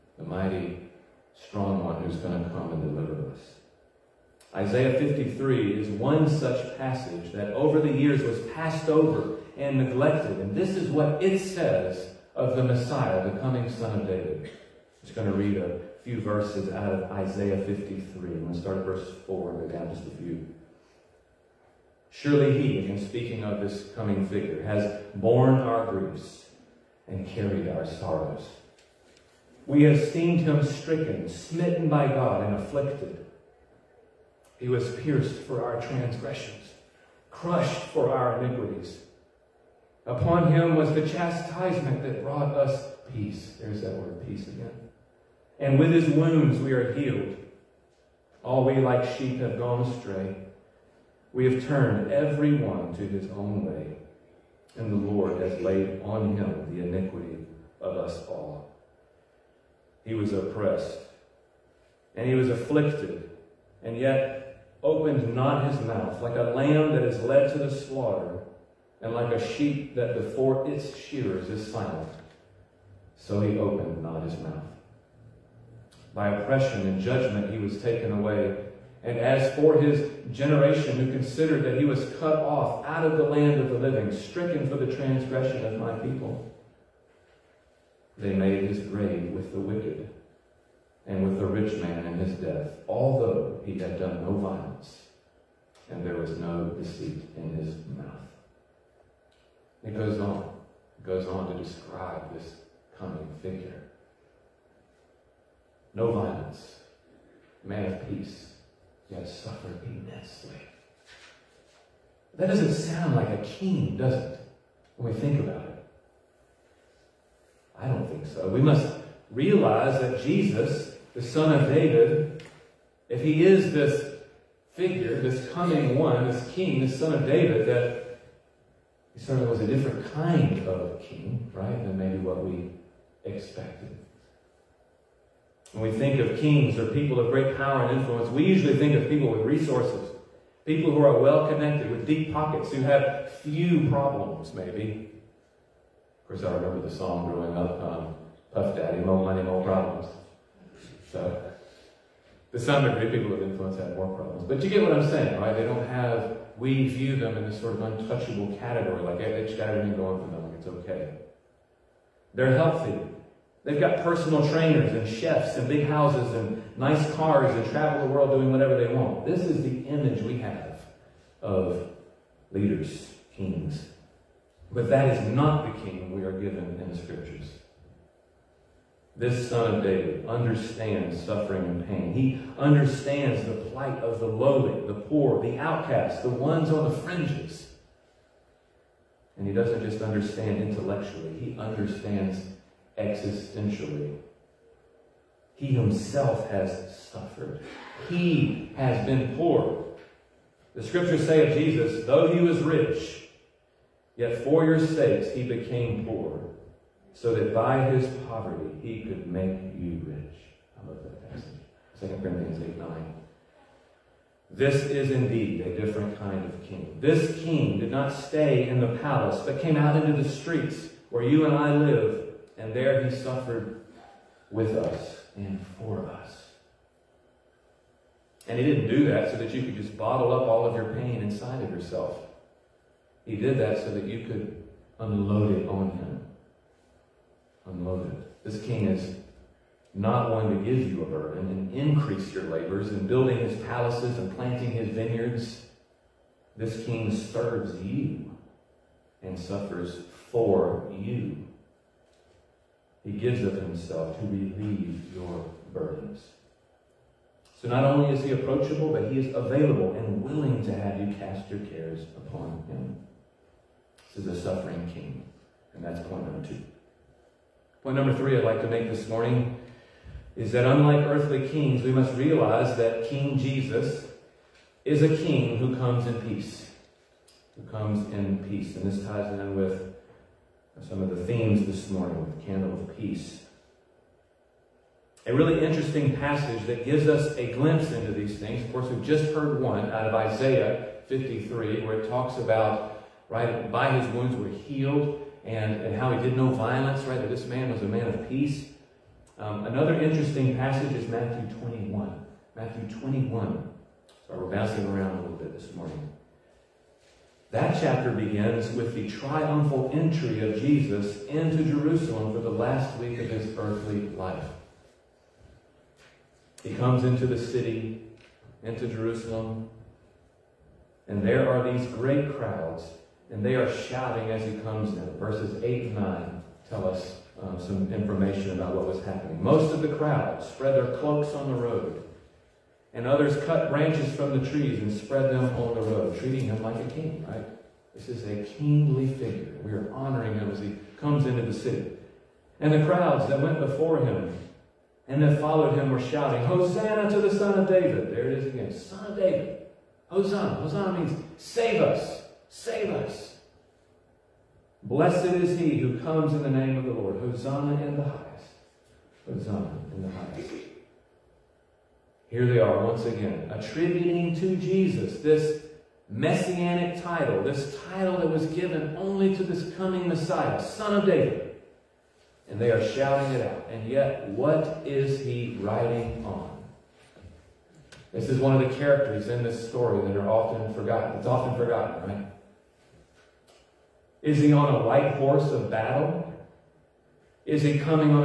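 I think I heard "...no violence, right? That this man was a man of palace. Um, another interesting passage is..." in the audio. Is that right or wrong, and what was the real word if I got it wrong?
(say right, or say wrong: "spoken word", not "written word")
wrong: "peace", not "palace".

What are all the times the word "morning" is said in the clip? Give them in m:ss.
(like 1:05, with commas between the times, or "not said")
4:29, 4:41, 5:05.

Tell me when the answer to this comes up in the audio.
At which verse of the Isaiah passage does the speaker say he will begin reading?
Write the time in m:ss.
0:18.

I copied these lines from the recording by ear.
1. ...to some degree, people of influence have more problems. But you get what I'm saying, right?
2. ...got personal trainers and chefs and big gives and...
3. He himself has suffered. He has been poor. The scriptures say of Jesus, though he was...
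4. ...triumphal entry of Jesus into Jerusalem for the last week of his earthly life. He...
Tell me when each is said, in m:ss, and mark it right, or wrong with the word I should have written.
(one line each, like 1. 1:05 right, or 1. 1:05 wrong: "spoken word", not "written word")
1. 2:32 right
2. 2:43 wrong: "houses", not "gives"
3. 3:15 right
4. 5:09 right.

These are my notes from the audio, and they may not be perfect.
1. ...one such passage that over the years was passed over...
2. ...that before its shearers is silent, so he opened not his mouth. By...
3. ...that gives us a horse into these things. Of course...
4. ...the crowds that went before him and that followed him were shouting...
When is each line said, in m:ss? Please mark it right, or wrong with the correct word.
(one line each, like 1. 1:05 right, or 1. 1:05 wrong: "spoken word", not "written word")
1. 0:05 right
2. 1:09 right
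3. 4:46 wrong: "glimpse", not "horse"
4. 5:42 right.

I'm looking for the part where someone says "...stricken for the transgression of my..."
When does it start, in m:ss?
1:24.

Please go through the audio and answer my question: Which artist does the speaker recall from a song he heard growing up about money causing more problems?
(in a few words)
Puff Daddy.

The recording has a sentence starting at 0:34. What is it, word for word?
He was pierced for our transgressions, crushed for our iniquities.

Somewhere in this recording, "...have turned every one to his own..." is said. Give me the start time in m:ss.
0:51.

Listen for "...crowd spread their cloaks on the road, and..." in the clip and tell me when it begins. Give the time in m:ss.
5:29.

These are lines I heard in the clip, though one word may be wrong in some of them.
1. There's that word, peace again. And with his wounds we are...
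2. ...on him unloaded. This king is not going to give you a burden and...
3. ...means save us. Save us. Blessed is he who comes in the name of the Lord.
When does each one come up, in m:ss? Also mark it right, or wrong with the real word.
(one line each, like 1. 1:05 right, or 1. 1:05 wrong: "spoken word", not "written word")
1. 0:43 right
2. 3:55 right
3. 5:50 right.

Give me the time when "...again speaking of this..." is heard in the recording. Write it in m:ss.
0:22.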